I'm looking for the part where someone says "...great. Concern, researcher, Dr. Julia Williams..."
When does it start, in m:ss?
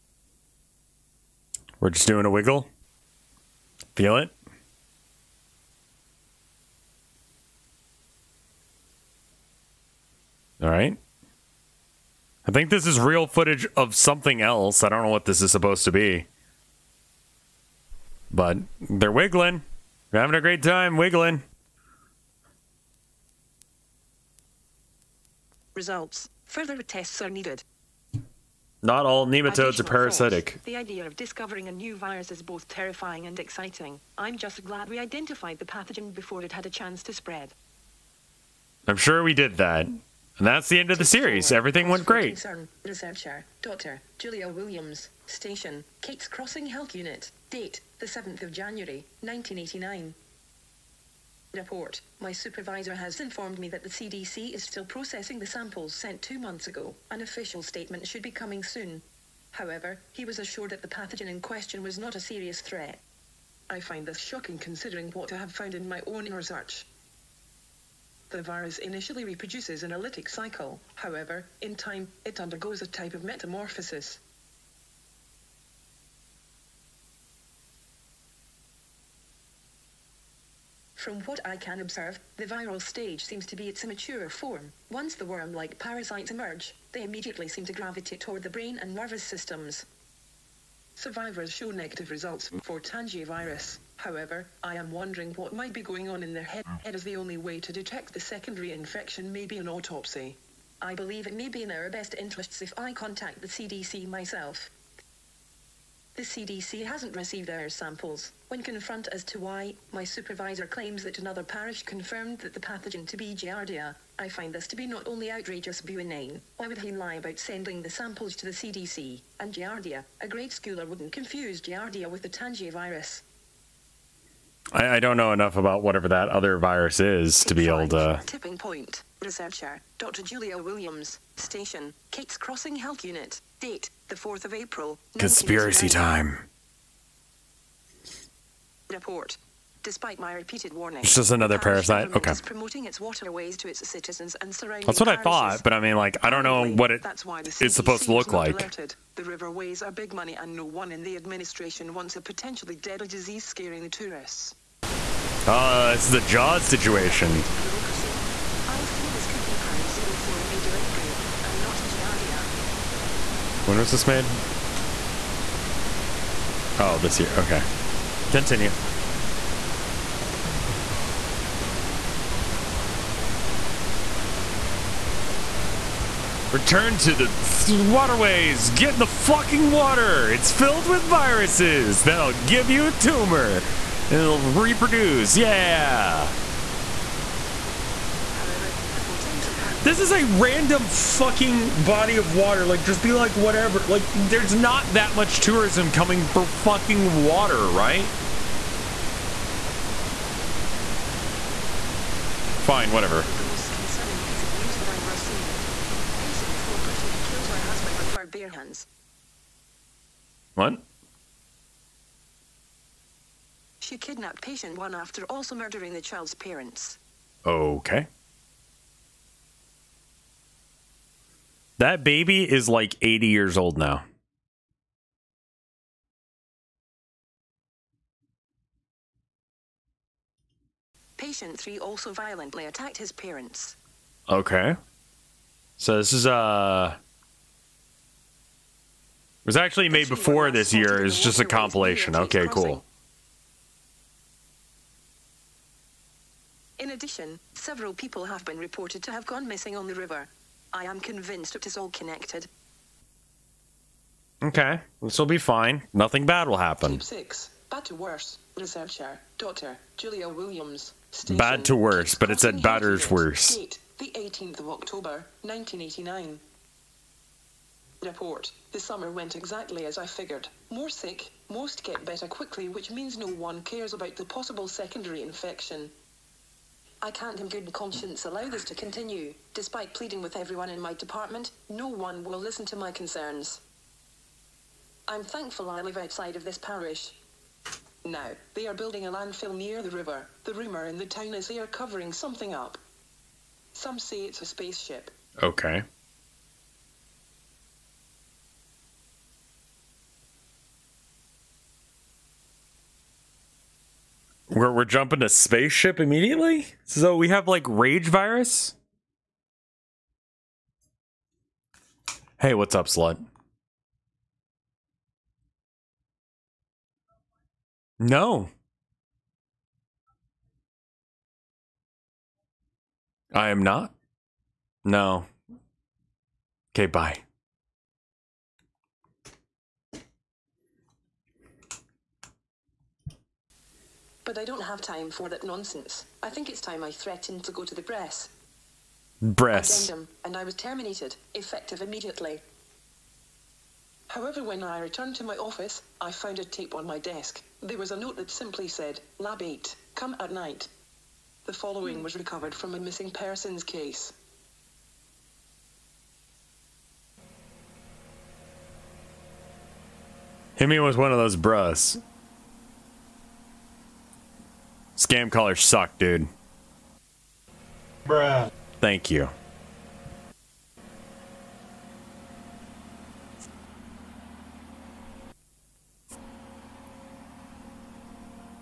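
0:42.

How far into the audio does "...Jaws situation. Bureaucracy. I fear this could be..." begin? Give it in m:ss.
2:36.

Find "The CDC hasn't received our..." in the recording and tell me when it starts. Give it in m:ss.
1:46.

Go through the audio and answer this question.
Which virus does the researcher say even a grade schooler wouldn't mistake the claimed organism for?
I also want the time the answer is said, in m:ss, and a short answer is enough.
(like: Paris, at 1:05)
Tangier virus, at 2:02.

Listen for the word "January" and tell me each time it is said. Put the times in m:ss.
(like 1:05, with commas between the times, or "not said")
0:48.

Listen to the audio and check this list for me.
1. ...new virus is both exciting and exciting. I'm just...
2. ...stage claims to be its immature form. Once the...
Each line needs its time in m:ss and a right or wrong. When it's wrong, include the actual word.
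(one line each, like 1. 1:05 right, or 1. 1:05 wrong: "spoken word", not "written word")
1. 0:31 wrong: "terrifying", not "exciting"
2. 1:22 wrong: "seems", not "claims".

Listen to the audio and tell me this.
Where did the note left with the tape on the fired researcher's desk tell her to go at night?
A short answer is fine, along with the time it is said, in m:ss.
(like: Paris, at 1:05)
Lab 8, at 5:49.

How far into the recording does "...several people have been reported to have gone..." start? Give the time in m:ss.
4:07.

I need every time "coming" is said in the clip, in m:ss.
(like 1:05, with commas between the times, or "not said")
0:58, 3:15.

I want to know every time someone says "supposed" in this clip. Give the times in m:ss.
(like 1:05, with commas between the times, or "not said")
0:15, 2:27.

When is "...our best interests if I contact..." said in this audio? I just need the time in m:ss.
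1:41.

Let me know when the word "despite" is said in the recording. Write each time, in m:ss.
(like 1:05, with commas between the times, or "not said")
2:19, 4:39.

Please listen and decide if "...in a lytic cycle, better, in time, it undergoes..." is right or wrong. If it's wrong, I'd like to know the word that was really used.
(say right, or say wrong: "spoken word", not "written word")
wrong: "however", not "better".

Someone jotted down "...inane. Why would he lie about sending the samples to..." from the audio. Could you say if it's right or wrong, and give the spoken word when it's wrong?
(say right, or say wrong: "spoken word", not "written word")
right.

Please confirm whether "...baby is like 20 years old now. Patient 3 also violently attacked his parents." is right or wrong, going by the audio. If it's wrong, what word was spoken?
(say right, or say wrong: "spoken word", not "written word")
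wrong: "80", not "20".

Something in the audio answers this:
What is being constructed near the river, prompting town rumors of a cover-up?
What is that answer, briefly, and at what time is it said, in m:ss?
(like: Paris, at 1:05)
A landfill, at 4:49.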